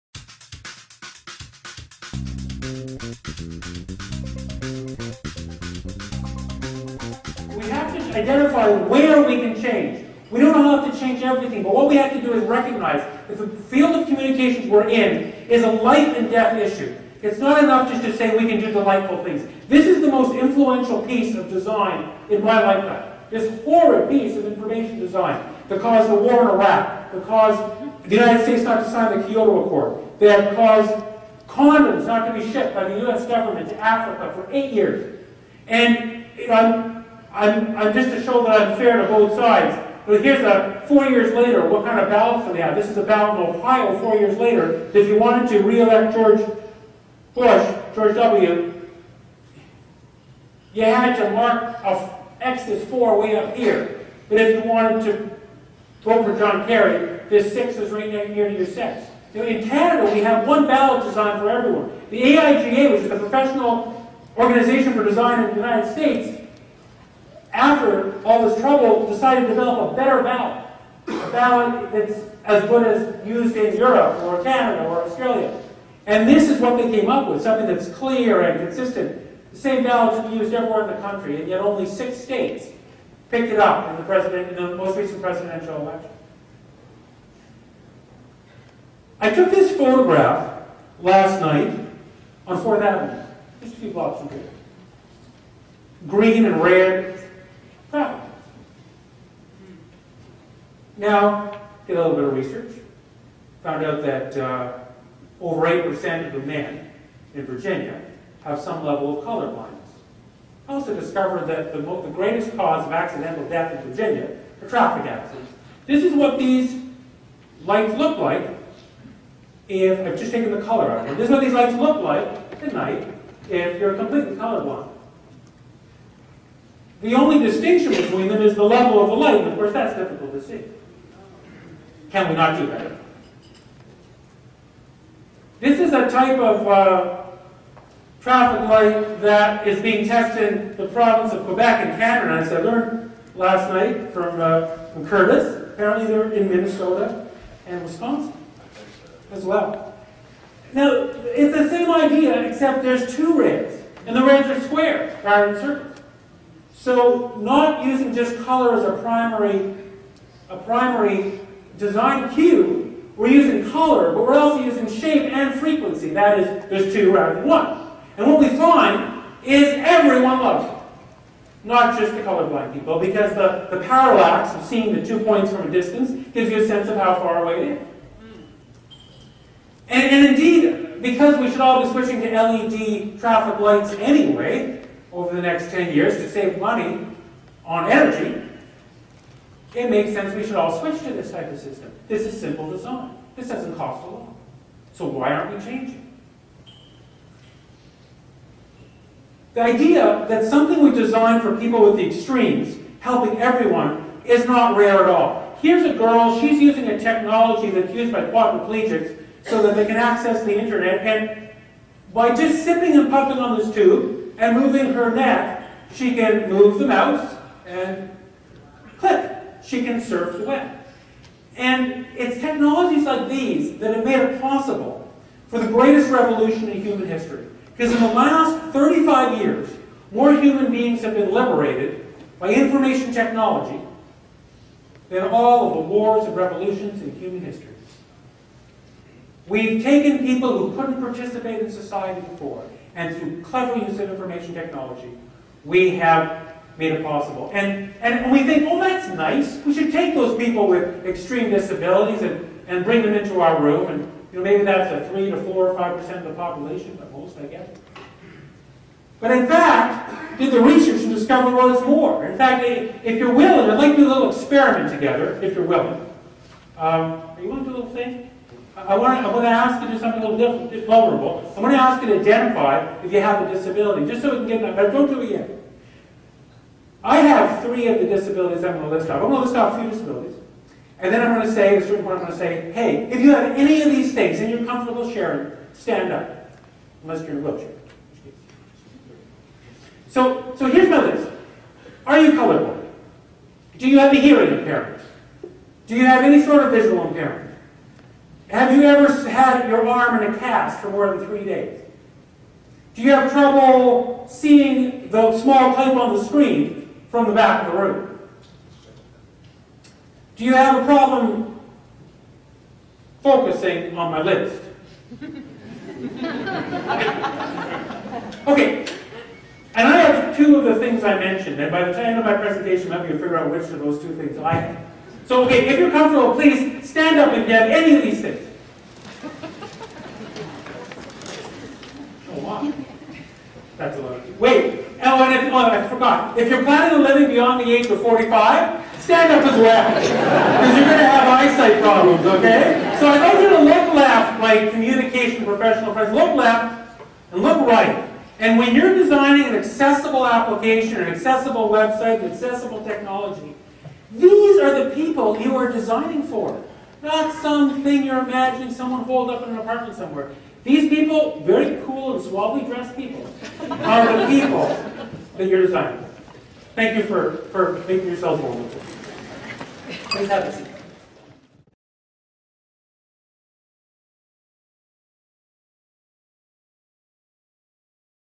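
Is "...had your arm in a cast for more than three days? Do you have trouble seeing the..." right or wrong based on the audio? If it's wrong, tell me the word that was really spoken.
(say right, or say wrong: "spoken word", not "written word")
right.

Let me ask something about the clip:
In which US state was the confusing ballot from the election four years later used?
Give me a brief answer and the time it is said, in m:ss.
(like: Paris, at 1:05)
Ohio, at 0:43.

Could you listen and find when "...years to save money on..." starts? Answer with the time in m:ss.
3:05.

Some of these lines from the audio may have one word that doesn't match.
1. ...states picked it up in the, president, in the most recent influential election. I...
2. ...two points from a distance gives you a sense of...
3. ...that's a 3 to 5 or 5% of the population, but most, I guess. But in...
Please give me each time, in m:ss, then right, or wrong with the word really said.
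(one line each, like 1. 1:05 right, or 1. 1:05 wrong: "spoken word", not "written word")
1. 1:22 wrong: "presidential", not "influential"
2. 2:55 right
3. 4:14 wrong: "4", not "5".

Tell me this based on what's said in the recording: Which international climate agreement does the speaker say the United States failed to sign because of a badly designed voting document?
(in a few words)
Kyoto Accord.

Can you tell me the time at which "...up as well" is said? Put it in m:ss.
5:39.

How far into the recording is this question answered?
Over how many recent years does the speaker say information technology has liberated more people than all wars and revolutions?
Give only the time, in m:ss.
3:48.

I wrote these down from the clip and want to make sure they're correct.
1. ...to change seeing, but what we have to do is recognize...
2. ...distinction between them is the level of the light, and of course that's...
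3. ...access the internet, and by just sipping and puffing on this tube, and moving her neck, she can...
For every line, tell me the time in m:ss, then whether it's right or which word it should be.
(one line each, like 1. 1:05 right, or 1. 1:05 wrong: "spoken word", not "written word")
1. 0:10 wrong: "everything", not "seeing"
2. 2:07 right
3. 3:29 right.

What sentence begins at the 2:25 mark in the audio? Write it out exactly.
Apparently they're in Minnesota and Wisconsin as well.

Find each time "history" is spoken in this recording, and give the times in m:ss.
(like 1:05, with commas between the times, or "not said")
3:47, 3:57.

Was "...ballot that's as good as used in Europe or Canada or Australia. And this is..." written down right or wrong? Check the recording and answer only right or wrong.
right.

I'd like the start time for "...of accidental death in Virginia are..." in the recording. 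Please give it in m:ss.
1:52.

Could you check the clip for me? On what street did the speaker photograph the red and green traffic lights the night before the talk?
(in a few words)
4th Avenue.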